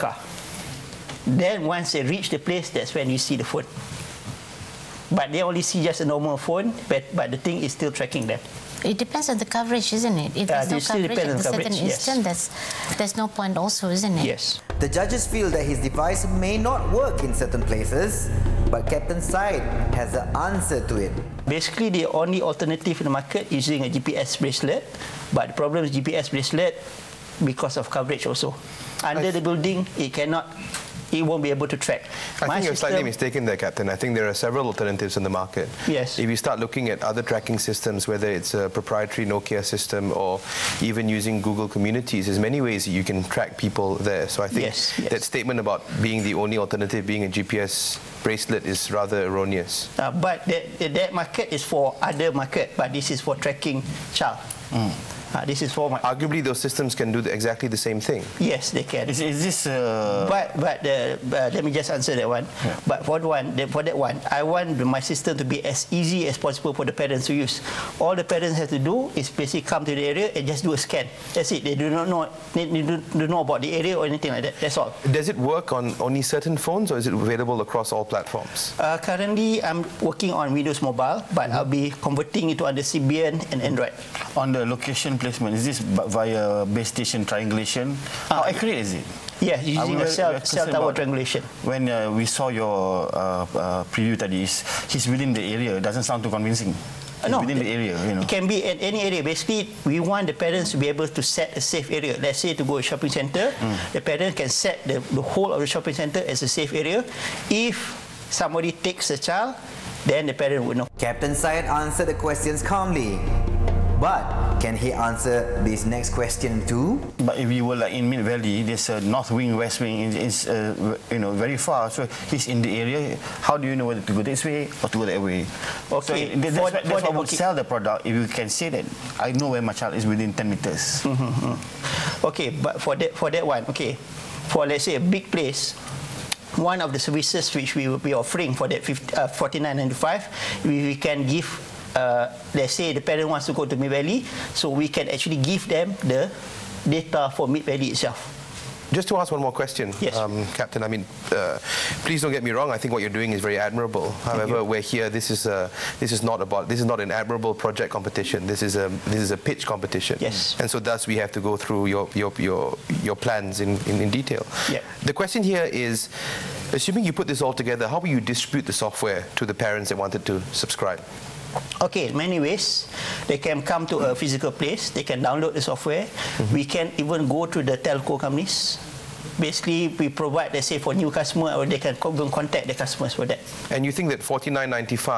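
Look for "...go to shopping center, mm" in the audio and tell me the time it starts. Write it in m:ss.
1:42.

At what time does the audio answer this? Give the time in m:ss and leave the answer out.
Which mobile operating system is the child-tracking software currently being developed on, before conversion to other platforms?
1:20.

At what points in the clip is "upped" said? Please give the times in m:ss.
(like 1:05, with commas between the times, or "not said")
not said.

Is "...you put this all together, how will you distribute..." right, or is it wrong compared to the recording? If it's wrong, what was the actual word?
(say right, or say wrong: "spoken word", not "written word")
right.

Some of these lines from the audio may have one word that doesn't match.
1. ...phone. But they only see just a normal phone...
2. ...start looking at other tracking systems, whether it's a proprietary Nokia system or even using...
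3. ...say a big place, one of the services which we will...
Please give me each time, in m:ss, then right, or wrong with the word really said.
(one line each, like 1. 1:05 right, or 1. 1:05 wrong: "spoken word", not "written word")
1. 0:03 right
2. 0:36 right
3. 2:14 right.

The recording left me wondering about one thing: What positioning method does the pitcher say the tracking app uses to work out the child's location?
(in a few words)
Cell tower triangulation.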